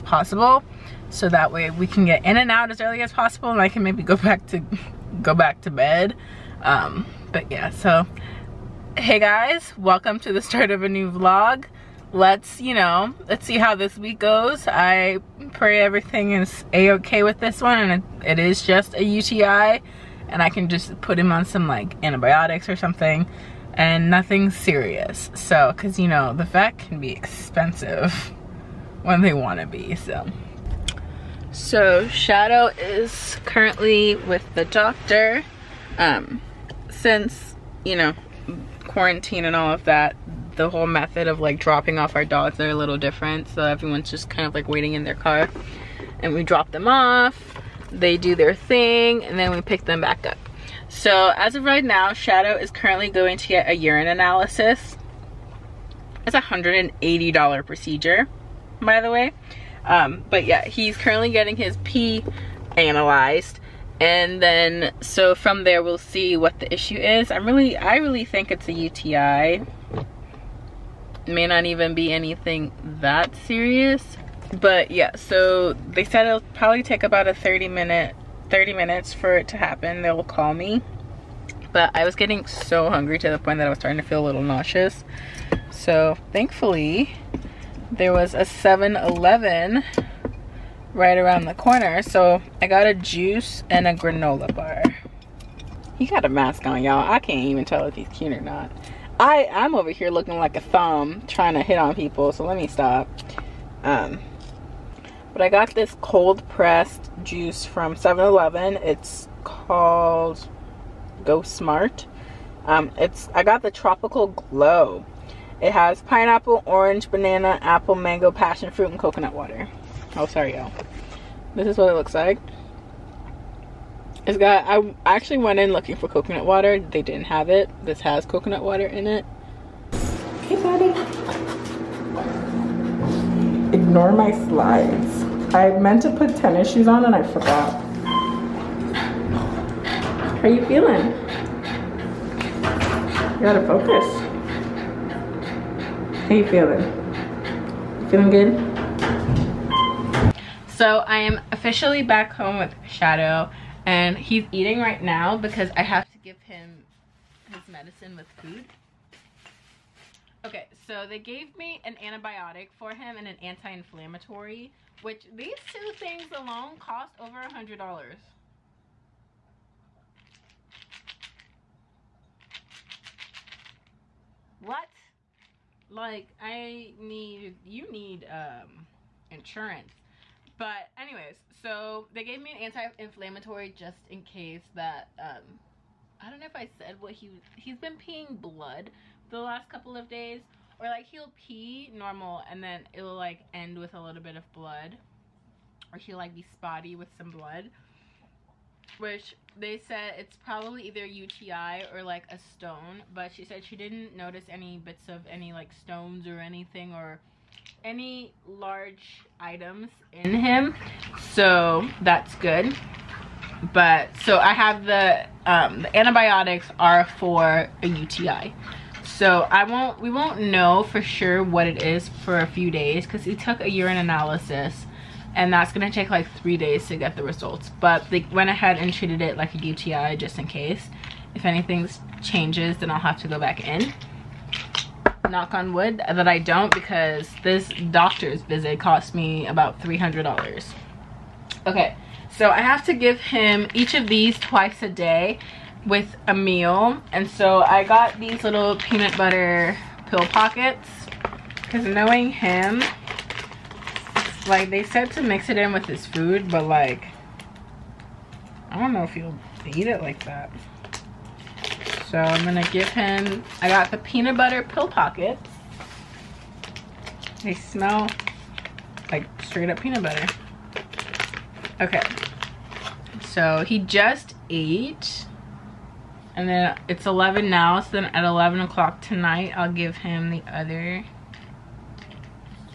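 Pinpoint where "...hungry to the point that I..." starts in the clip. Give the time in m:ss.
1:22.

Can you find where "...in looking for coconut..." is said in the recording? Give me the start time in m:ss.
2:05.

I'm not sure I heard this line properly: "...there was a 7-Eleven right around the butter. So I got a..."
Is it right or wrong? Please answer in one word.
wrong.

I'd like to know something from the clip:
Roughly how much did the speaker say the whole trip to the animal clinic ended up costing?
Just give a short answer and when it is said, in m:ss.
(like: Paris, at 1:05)
$300, at 3:59.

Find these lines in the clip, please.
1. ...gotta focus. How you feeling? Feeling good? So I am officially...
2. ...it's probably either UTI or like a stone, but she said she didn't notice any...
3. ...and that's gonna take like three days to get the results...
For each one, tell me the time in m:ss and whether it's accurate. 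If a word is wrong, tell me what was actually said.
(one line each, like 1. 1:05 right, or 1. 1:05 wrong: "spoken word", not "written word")
1. 2:23 right
2. 3:20 right
3. 3:45 right.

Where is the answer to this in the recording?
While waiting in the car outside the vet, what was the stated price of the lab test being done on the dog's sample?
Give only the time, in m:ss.
0:56.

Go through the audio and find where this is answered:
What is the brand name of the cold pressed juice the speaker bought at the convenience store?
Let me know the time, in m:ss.
1:51.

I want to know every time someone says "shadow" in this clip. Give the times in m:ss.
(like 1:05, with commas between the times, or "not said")
0:32, 0:52, 2:32.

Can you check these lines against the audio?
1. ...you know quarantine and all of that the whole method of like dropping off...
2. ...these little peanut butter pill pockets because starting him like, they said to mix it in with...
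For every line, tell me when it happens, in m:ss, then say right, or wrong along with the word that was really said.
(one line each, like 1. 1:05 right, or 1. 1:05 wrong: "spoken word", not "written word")
1. 0:37 right
2. 4:08 wrong: "knowing", not "starting".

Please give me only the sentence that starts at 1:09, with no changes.
It may not even be anything that serious.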